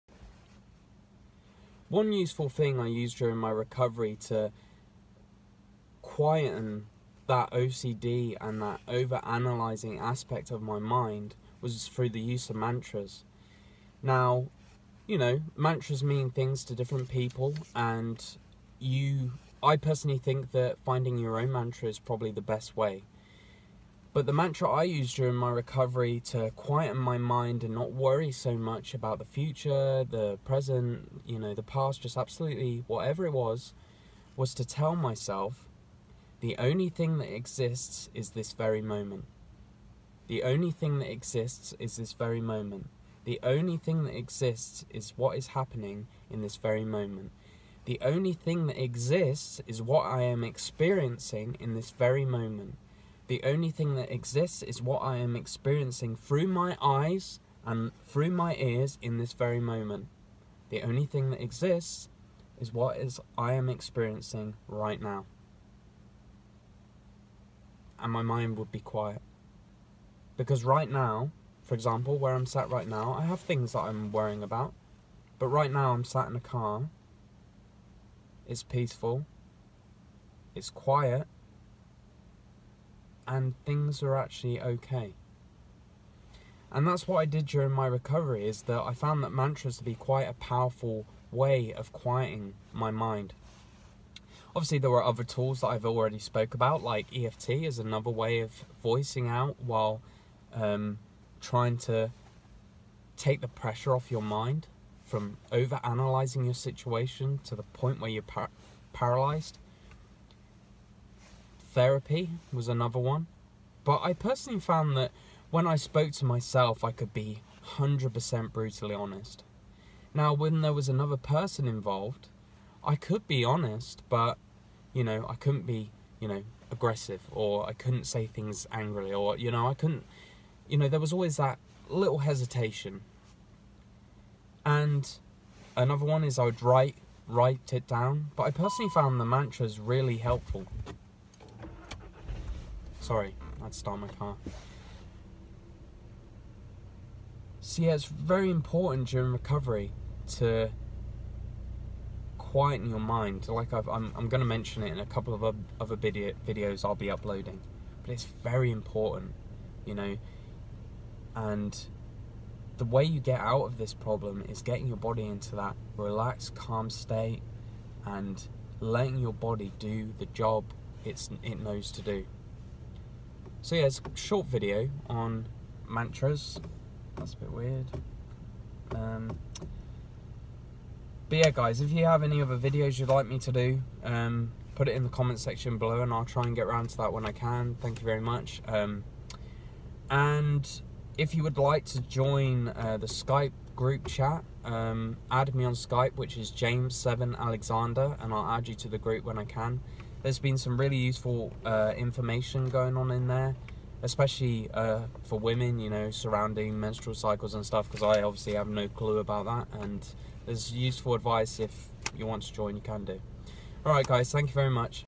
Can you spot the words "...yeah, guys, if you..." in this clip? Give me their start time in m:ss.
3:01.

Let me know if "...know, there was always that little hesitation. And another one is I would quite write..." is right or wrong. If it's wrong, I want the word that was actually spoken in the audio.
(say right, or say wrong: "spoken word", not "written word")
wrong: "write", not "quite".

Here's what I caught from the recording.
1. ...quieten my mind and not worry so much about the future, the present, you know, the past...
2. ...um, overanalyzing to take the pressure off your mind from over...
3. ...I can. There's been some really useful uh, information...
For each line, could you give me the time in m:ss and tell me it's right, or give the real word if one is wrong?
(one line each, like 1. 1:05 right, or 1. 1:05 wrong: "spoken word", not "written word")
1. 0:26 right
2. 1:40 wrong: "trying", not "overanalyzing"
3. 3:19 right.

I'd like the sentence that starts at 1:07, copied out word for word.
And my mind would be quiet.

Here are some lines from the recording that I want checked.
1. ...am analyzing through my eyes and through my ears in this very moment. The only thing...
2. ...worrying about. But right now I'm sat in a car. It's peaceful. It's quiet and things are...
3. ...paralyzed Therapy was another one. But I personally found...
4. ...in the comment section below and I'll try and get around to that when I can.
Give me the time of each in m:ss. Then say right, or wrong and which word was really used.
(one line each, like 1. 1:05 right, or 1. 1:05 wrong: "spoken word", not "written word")
1. 0:55 wrong: "experiencing", not "analyzing"
2. 1:14 right
3. 1:48 right
4. 3:04 right.